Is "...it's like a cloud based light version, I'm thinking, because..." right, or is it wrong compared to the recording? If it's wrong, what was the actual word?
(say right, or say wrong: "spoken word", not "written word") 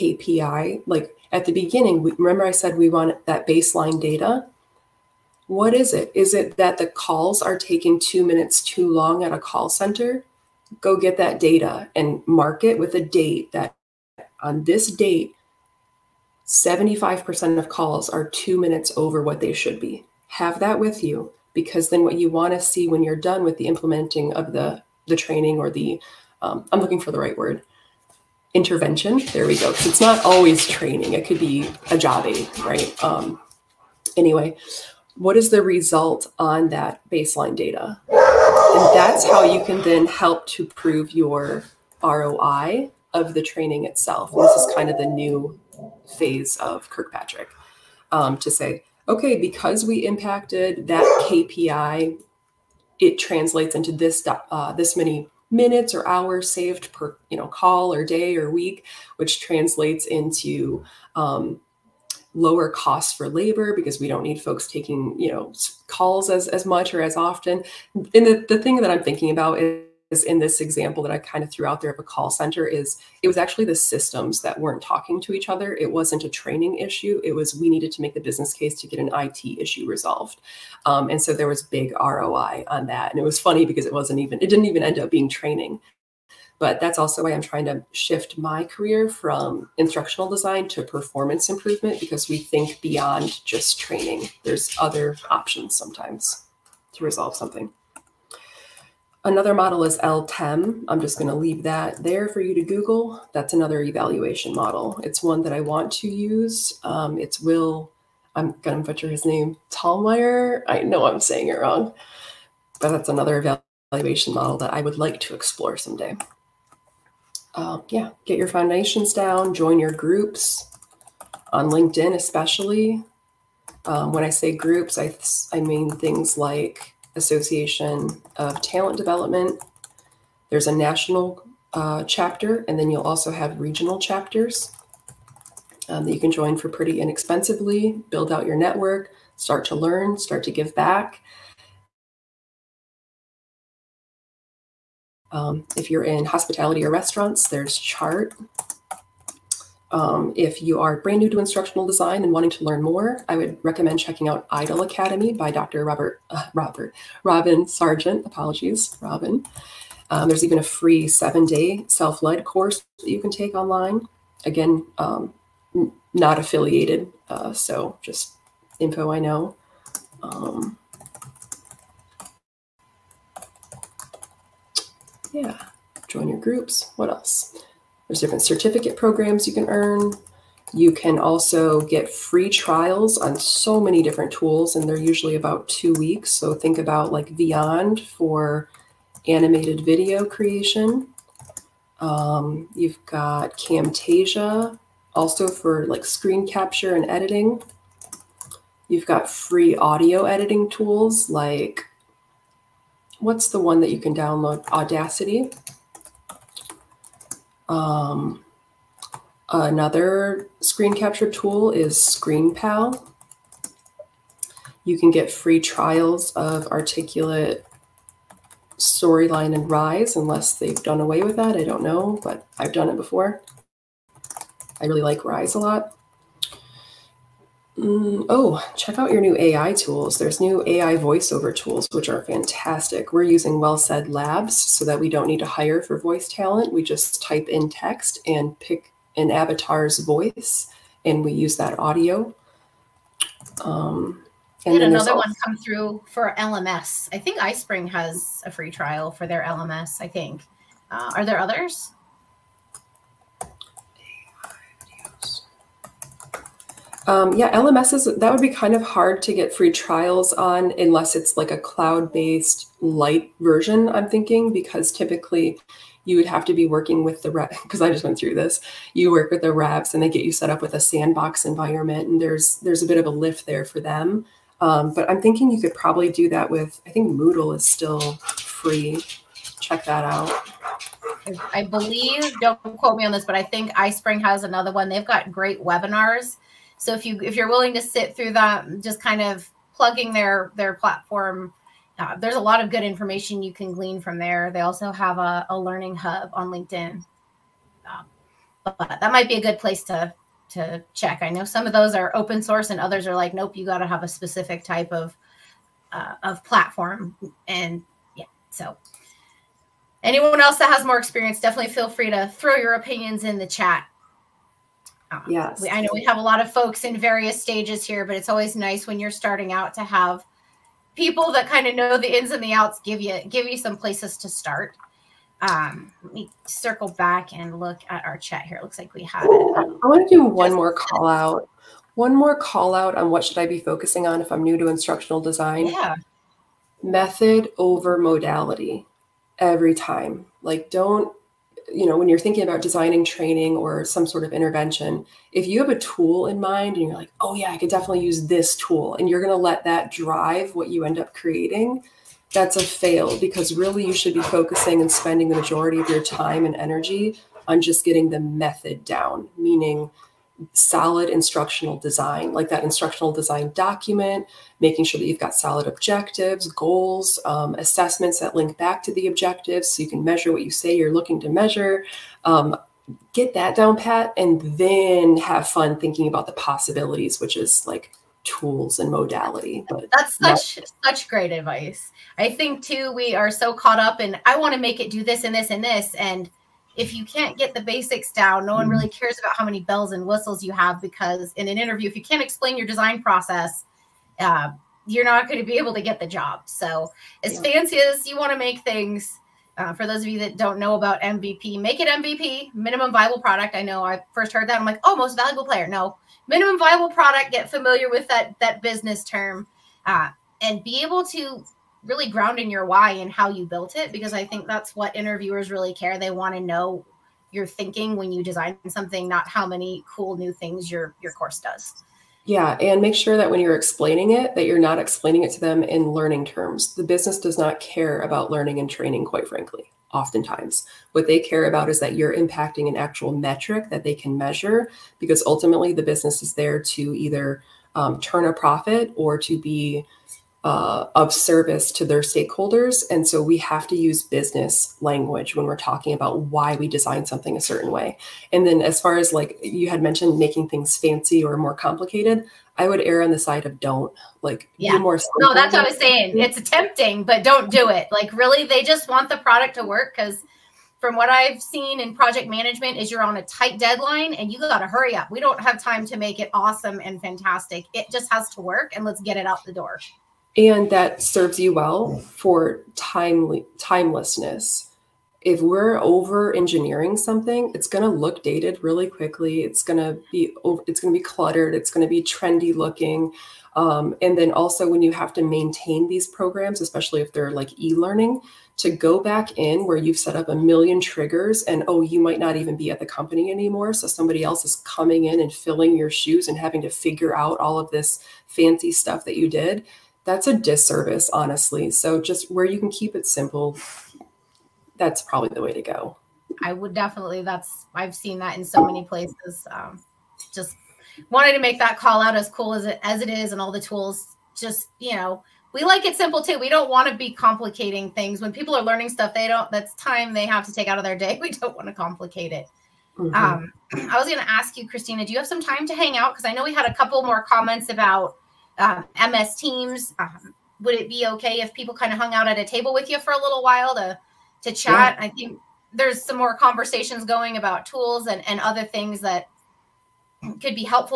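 right.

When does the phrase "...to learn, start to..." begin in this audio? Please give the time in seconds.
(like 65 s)
139 s.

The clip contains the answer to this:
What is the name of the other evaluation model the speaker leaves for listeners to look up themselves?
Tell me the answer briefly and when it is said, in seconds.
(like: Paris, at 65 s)
LTEM, at 99 s.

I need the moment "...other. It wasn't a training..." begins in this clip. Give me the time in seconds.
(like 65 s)
75 s.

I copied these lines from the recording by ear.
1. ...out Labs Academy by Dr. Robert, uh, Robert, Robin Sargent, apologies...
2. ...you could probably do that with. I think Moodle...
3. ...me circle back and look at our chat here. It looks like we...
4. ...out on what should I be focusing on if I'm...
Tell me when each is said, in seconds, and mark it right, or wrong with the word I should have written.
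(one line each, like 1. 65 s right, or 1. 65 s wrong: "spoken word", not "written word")
1. 154 s wrong: "IDOL", not "Labs"
2. 275 s right
3. 326 s right
4. 332 s right.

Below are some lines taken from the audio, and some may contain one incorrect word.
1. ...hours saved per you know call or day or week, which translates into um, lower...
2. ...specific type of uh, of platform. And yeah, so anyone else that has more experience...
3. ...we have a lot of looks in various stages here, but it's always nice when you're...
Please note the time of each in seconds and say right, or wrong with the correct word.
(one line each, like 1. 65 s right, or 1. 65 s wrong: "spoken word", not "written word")
1. 56 s right
2. 304 s right
3. 315 s wrong: "folks", not "looks".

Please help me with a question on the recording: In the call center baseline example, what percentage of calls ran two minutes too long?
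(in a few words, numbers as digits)
75%.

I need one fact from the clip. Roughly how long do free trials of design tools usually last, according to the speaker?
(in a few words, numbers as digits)
2 weeks.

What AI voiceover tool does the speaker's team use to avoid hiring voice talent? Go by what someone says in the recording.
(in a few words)
WellSaid Labs.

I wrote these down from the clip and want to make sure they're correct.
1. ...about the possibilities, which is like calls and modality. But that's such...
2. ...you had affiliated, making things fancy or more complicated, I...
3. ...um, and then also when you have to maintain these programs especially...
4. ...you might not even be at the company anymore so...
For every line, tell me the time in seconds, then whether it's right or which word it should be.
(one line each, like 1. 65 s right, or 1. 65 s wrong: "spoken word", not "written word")
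1. 376 s wrong: "tools", not "calls"
2. 449 s wrong: "mentioned", not "affiliated"
3. 483 s right
4. 491 s right.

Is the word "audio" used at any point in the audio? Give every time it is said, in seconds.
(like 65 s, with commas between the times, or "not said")
199 s, 241 s.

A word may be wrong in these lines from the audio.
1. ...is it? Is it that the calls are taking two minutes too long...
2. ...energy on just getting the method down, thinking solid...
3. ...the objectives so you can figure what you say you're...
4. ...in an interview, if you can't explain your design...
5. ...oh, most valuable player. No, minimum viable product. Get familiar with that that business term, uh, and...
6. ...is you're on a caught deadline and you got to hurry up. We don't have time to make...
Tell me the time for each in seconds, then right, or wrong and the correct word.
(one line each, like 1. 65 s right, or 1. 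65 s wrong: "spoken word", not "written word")
1. 5 s right
2. 356 s wrong: "meaning", not "thinking"
3. 368 s wrong: "measure", not "figure"
4. 391 s right
5. 404 s right
6. 462 s wrong: "tight", not "caught".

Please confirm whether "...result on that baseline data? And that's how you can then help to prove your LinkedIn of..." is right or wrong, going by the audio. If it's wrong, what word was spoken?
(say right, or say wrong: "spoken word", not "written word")
wrong: "ROI", not "LinkedIn".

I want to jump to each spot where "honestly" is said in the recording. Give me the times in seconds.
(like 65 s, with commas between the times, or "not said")
501 s.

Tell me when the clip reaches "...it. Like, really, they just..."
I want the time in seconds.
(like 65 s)
457 s.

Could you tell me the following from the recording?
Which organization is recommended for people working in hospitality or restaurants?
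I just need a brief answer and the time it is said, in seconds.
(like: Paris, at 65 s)
Chart, at 147 s.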